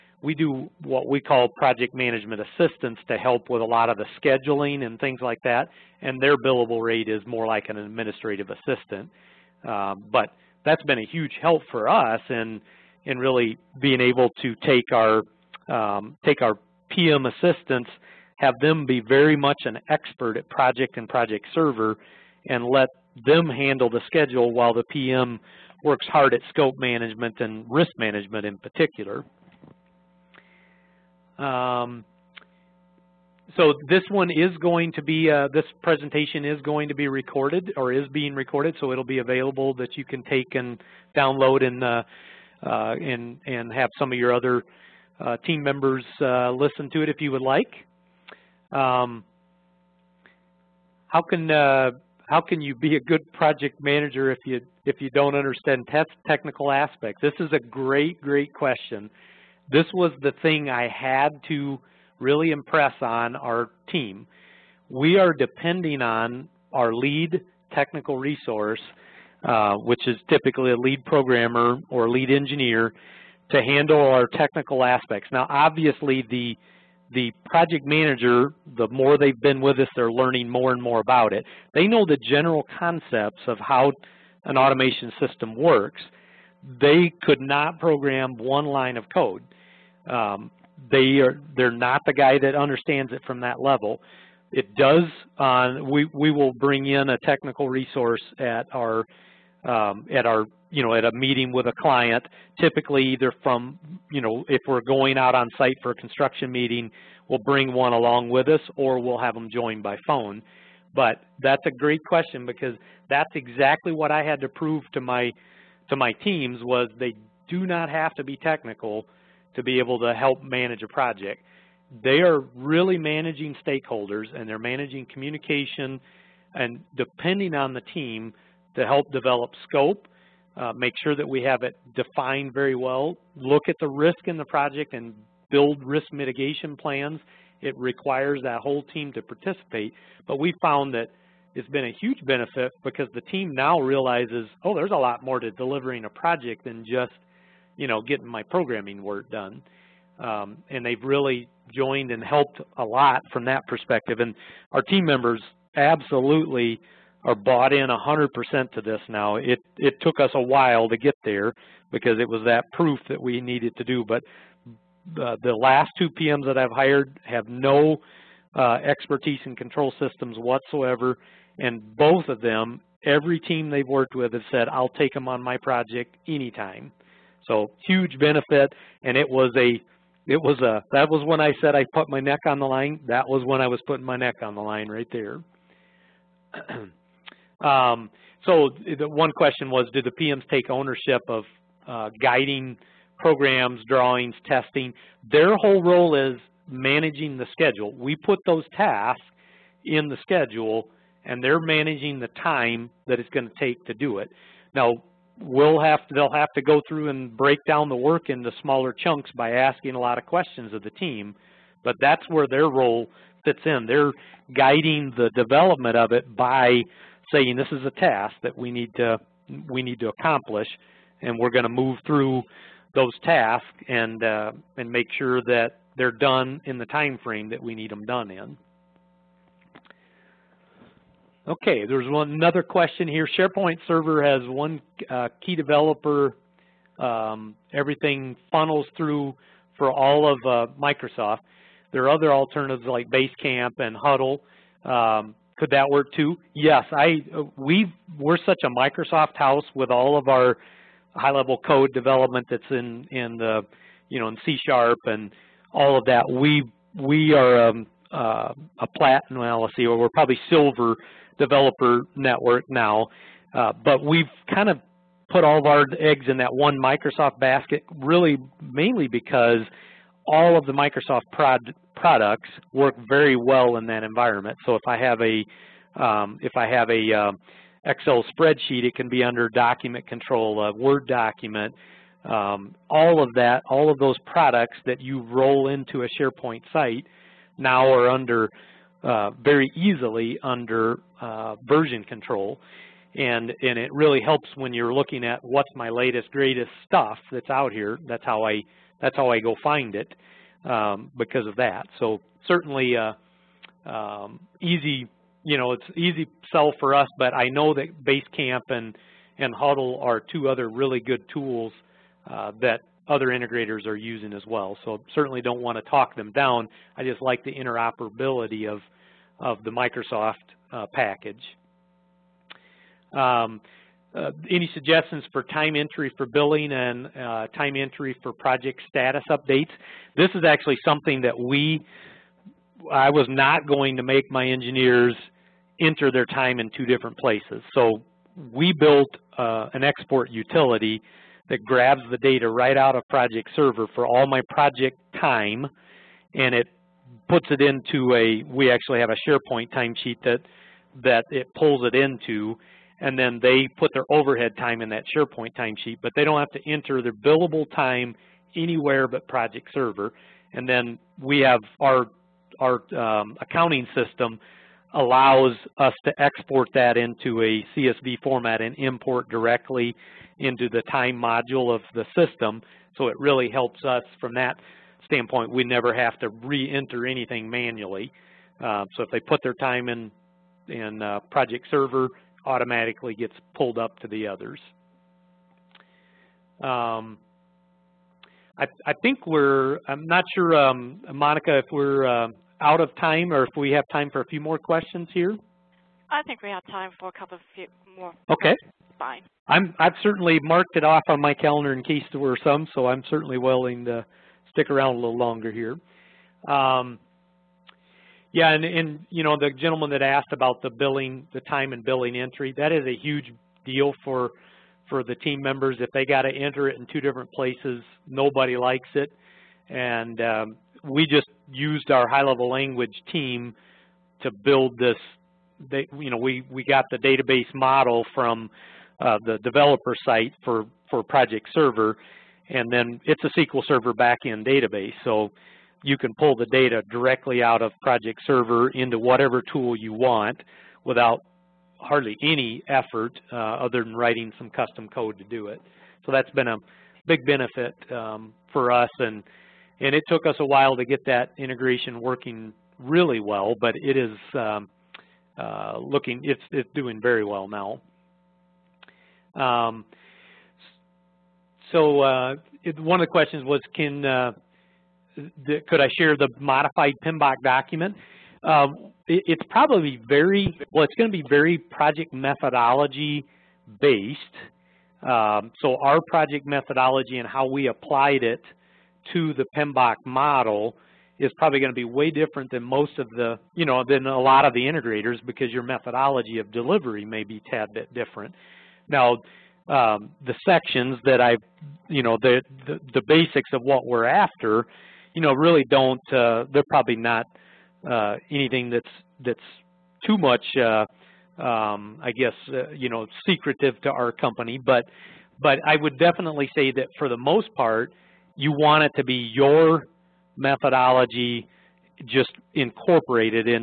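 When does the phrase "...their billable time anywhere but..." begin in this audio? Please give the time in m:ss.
5:57.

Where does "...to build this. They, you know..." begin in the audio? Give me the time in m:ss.
7:04.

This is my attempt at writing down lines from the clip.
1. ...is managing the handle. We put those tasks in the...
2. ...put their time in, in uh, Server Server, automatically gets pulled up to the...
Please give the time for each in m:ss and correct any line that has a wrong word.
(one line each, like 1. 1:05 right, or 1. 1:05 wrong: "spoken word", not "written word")
1. 3:16 wrong: "schedule", not "handle"
2. 6:19 wrong: "Project", not "Server".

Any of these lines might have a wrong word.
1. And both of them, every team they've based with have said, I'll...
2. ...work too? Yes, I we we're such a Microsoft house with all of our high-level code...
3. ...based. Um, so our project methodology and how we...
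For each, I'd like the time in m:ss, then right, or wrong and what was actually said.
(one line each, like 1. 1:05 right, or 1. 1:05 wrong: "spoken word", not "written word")
1. 2:51 wrong: "worked", not "based"
2. 4:05 right
3. 7:53 right.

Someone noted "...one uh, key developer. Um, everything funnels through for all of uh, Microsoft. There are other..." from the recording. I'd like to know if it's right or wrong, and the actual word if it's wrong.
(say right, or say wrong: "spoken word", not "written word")
right.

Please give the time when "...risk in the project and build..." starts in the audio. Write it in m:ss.
2:13.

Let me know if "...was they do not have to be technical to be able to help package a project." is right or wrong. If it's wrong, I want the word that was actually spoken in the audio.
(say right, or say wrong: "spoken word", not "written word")
wrong: "manage", not "package".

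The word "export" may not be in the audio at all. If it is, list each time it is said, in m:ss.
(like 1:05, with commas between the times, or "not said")
5:39, 6:06.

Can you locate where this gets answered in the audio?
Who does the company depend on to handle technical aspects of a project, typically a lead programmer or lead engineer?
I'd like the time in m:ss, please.
1:06.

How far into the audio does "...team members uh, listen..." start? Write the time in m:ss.
0:45.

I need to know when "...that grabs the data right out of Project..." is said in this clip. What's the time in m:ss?
5:41.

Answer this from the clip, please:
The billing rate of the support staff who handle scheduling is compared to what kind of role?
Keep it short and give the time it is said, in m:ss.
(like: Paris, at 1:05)
administrative assistant, at 0:07.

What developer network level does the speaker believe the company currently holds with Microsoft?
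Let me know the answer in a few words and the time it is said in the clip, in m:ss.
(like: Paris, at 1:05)
silver, at 4:20.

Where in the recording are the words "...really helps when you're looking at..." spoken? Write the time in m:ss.
4:53.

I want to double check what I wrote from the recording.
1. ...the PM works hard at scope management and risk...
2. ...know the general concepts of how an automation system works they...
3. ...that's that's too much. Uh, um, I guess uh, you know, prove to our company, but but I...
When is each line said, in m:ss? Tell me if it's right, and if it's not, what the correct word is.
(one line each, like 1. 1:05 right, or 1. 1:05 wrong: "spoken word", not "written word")
1. 0:24 right
2. 1:21 right
3. 8:18 wrong: "secretive", not "prove".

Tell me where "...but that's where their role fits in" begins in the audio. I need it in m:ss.
3:31.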